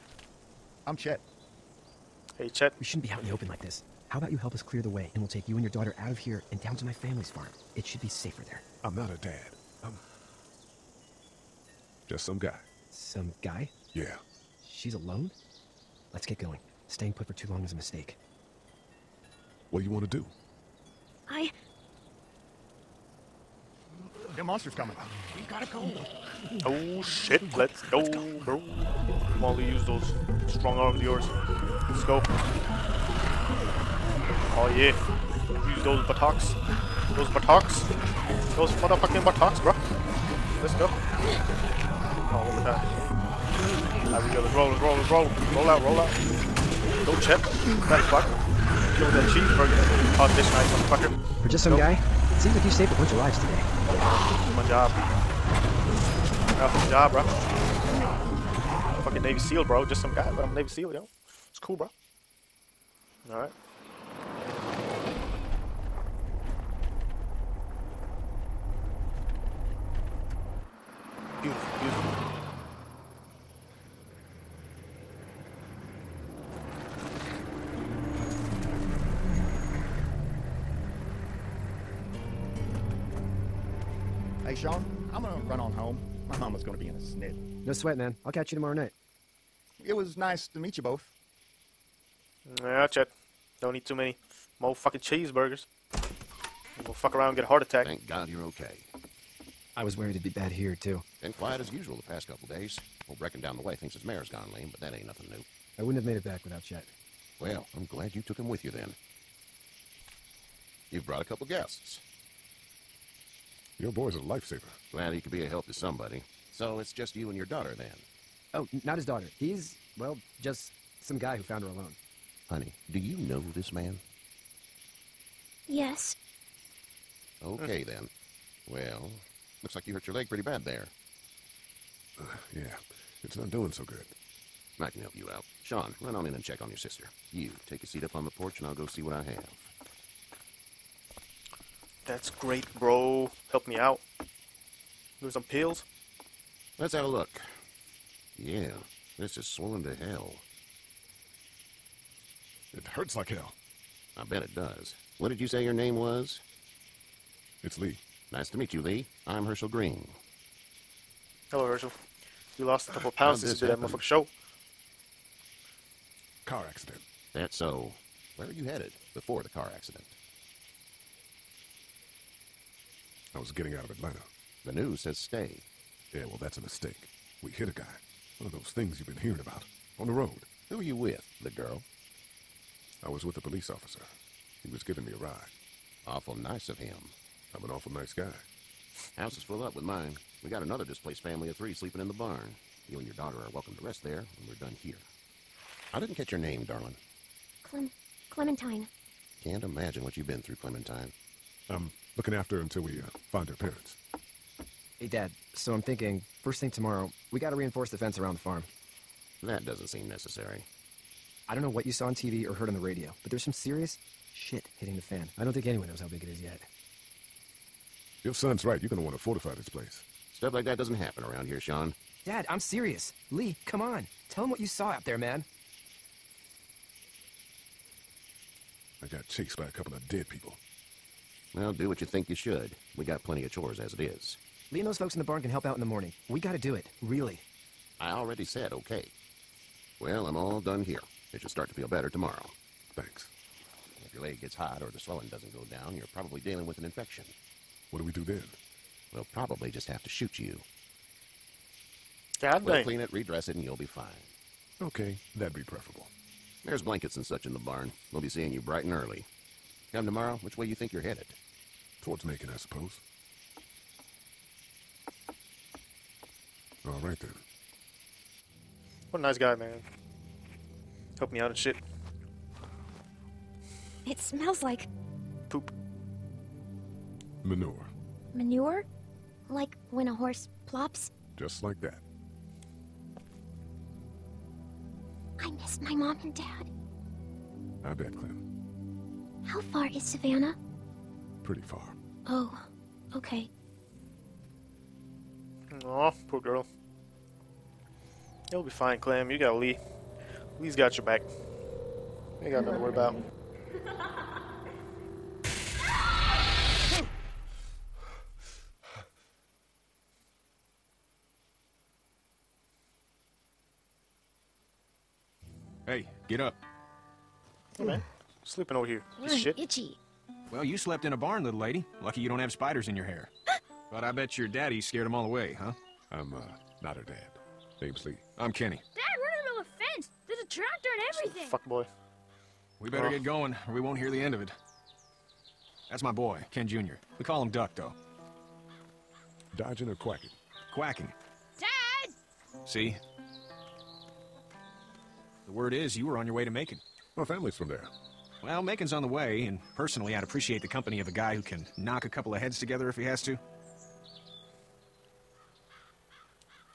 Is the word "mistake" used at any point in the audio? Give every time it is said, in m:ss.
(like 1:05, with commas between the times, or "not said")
0:17, 2:56.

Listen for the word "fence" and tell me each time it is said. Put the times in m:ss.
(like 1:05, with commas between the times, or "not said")
3:27, 5:29.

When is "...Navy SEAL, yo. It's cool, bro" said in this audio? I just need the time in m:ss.
1:00.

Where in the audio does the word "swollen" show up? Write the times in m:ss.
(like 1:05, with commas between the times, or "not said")
2:29.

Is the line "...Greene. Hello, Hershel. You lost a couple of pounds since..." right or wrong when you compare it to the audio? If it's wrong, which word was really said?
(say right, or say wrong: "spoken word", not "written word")
right.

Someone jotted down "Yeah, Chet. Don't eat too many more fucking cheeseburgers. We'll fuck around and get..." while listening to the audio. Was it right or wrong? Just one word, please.
right.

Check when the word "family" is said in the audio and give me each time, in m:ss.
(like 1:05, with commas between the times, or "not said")
0:06, 3:11, 5:47.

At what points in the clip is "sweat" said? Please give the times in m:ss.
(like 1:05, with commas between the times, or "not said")
1:27.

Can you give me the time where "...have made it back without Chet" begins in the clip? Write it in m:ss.
1:46.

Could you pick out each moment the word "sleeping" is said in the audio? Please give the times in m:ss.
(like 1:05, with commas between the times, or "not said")
3:11, 5:18.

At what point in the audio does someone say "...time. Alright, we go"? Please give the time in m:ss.
0:42.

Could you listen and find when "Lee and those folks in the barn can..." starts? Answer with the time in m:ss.
3:54.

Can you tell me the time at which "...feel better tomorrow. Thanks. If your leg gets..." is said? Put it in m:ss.
4:01.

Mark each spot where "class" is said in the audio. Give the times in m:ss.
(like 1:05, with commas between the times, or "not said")
not said.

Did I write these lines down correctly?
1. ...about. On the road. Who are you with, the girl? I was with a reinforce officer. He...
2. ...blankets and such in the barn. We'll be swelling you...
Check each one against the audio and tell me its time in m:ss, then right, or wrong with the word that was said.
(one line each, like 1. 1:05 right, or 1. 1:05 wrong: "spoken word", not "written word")
1. 2:59 wrong: "police", not "reinforce"
2. 4:16 wrong: "seeing", not "swelling".